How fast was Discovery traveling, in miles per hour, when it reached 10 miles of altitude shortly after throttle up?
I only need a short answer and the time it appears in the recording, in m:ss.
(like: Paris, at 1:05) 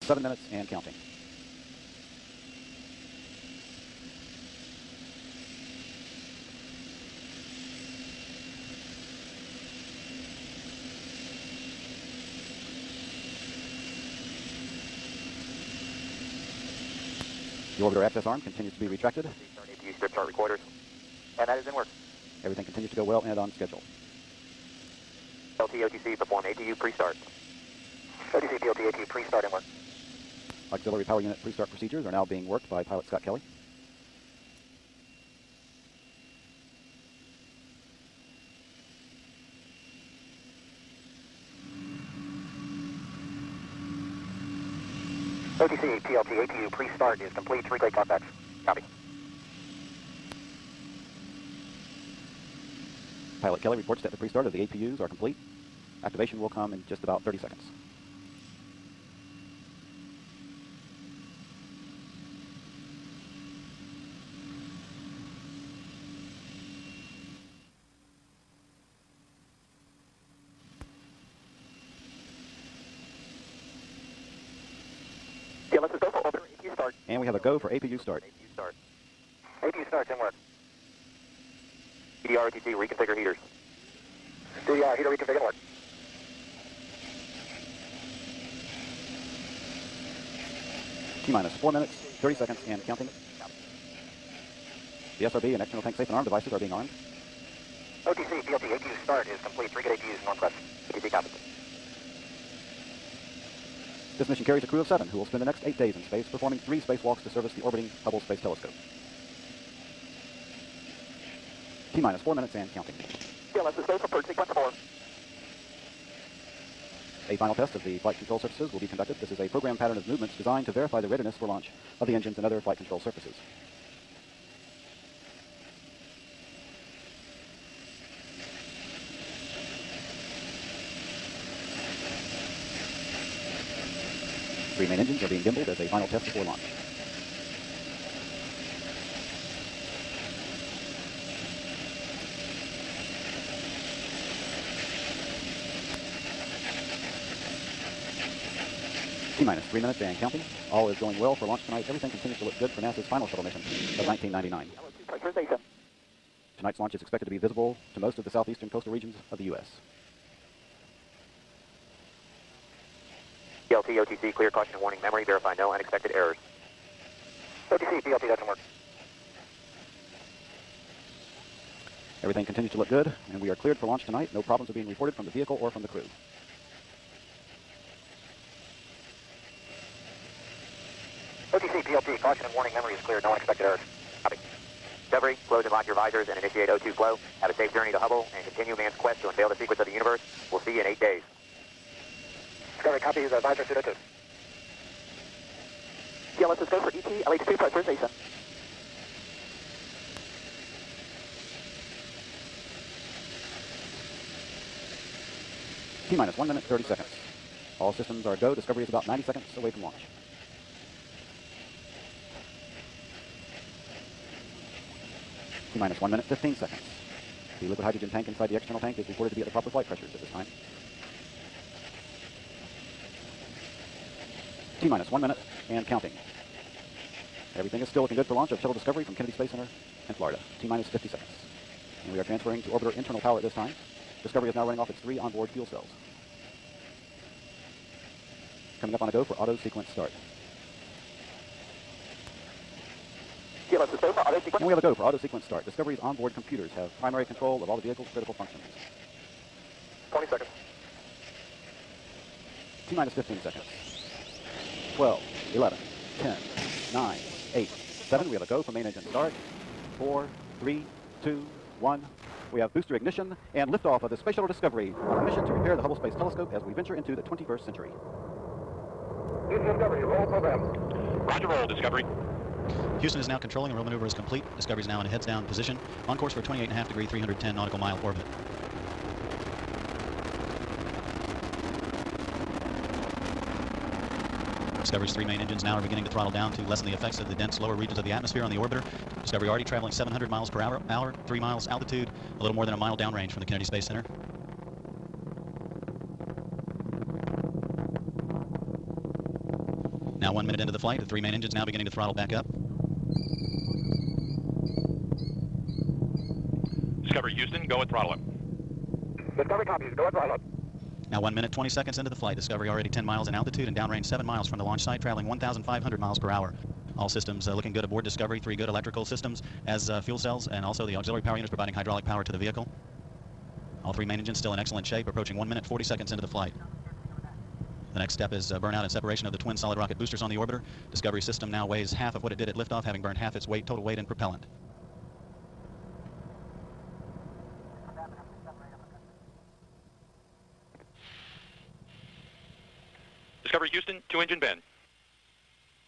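1,500 mph, at 5:15.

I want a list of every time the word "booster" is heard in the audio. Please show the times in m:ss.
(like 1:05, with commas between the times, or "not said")
4:22, 5:29.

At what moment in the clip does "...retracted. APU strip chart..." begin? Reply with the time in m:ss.
0:18.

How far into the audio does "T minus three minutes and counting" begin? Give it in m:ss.
2:29.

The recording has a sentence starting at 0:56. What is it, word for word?
Activation will come in just about 30 seconds.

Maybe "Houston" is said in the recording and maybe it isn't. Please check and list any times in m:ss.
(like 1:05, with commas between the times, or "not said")
4:32, 5:07, 5:43.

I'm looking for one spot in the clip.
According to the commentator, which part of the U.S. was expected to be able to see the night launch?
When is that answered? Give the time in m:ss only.
2:38.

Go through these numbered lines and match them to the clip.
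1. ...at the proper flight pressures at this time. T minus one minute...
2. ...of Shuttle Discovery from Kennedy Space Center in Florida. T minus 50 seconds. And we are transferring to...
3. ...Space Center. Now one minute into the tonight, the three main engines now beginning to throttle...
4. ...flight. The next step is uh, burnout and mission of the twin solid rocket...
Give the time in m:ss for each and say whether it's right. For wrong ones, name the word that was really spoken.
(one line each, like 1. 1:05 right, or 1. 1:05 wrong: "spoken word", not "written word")
1. 3:39 right
2. 3:48 right
3. 4:53 wrong: "flight", not "tonight"
4. 5:26 wrong: "separation", not "mission".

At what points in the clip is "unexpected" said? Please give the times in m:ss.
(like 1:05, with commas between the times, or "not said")
2:45, 3:03.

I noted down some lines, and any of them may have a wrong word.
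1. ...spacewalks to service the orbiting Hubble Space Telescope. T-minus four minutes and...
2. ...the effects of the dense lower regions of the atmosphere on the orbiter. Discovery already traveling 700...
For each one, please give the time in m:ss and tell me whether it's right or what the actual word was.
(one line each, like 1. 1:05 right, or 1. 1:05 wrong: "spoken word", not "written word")
1. 1:46 right
2. 4:46 right.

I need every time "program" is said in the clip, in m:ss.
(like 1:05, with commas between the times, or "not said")
1:59, 4:30.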